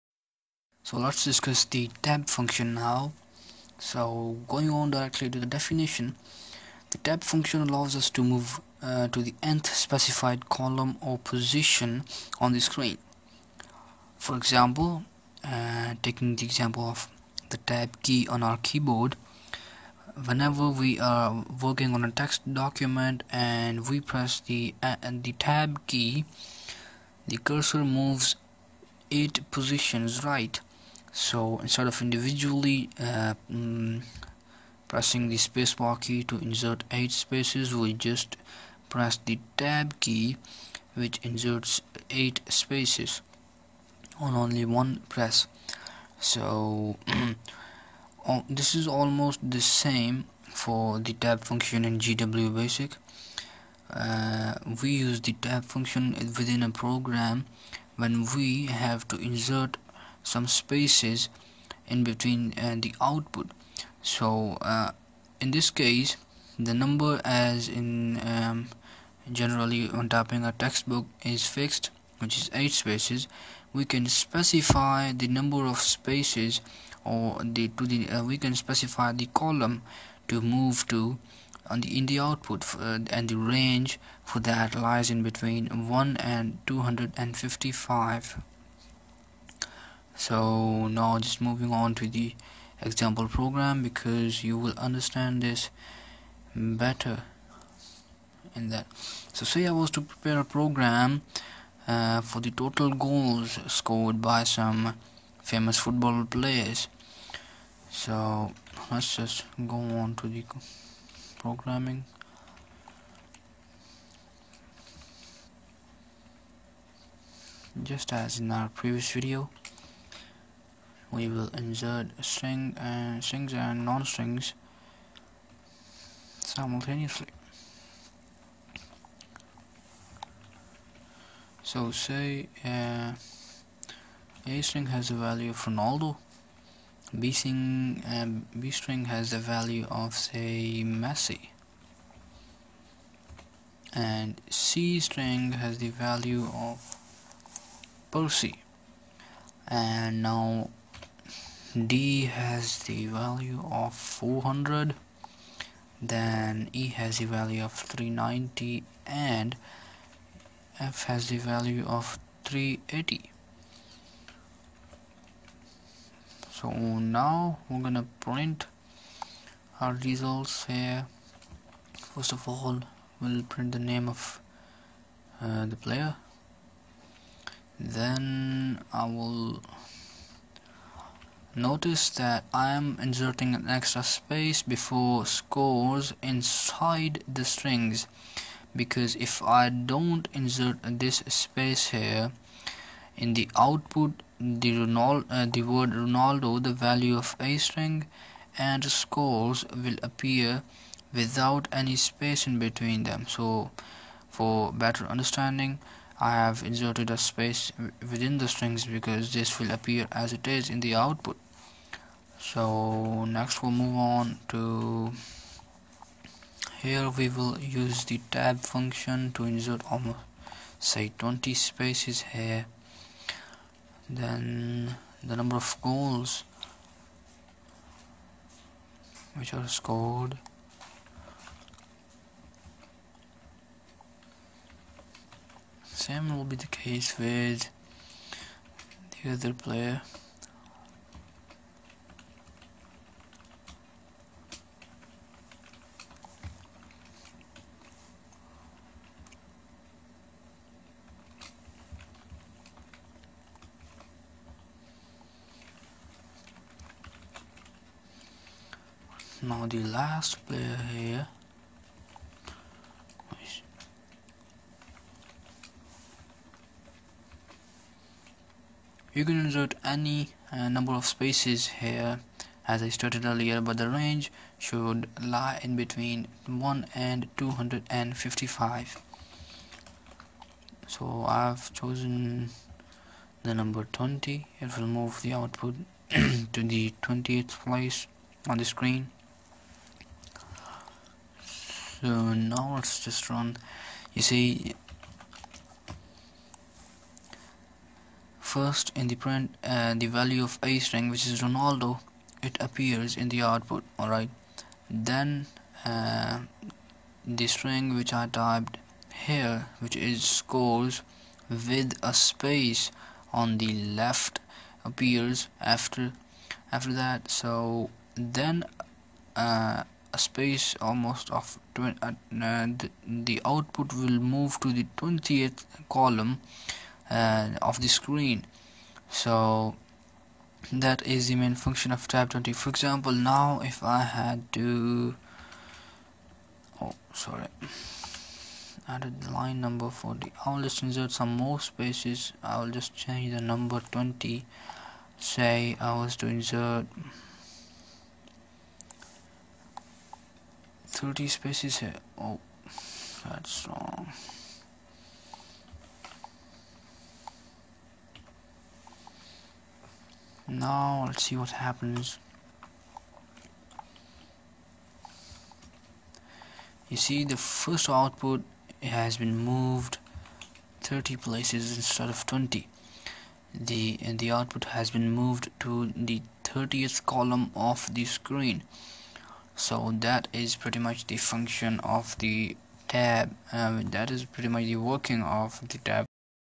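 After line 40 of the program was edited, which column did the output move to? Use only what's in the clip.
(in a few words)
30.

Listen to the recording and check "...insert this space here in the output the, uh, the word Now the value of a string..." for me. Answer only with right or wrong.
wrong.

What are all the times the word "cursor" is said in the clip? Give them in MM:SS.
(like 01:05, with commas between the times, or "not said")
00:27.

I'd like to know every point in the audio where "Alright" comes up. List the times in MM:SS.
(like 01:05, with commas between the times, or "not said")
05:03.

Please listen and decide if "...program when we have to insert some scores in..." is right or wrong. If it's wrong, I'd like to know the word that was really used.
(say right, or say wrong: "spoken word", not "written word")
wrong: "spaces", not "scores".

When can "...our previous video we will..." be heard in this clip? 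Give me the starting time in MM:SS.
01:58.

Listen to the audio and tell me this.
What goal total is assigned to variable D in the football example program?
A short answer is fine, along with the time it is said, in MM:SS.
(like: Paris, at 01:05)
400, at 02:33.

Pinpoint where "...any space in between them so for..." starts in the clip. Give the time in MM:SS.
03:21.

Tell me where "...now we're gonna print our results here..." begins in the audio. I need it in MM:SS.
02:46.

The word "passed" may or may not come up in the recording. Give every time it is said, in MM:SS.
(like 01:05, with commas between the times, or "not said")
not said.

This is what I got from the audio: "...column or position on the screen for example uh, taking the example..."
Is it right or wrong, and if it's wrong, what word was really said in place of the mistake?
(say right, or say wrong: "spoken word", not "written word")
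right.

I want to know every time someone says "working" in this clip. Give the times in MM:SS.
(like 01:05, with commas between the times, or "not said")
00:21, 06:24.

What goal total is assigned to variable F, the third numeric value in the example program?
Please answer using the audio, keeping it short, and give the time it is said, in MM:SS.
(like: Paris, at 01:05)
380, at 02:42.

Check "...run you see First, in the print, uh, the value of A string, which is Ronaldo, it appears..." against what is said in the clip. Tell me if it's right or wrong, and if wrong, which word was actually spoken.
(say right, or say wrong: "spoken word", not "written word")
right.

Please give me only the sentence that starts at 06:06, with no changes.
You see the first output has been moved 30 places instead of 20.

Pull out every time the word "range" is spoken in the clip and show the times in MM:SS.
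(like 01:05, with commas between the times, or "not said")
01:23, 04:33.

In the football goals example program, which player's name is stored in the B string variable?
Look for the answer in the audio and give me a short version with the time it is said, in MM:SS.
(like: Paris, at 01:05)
Messi, at 02:20.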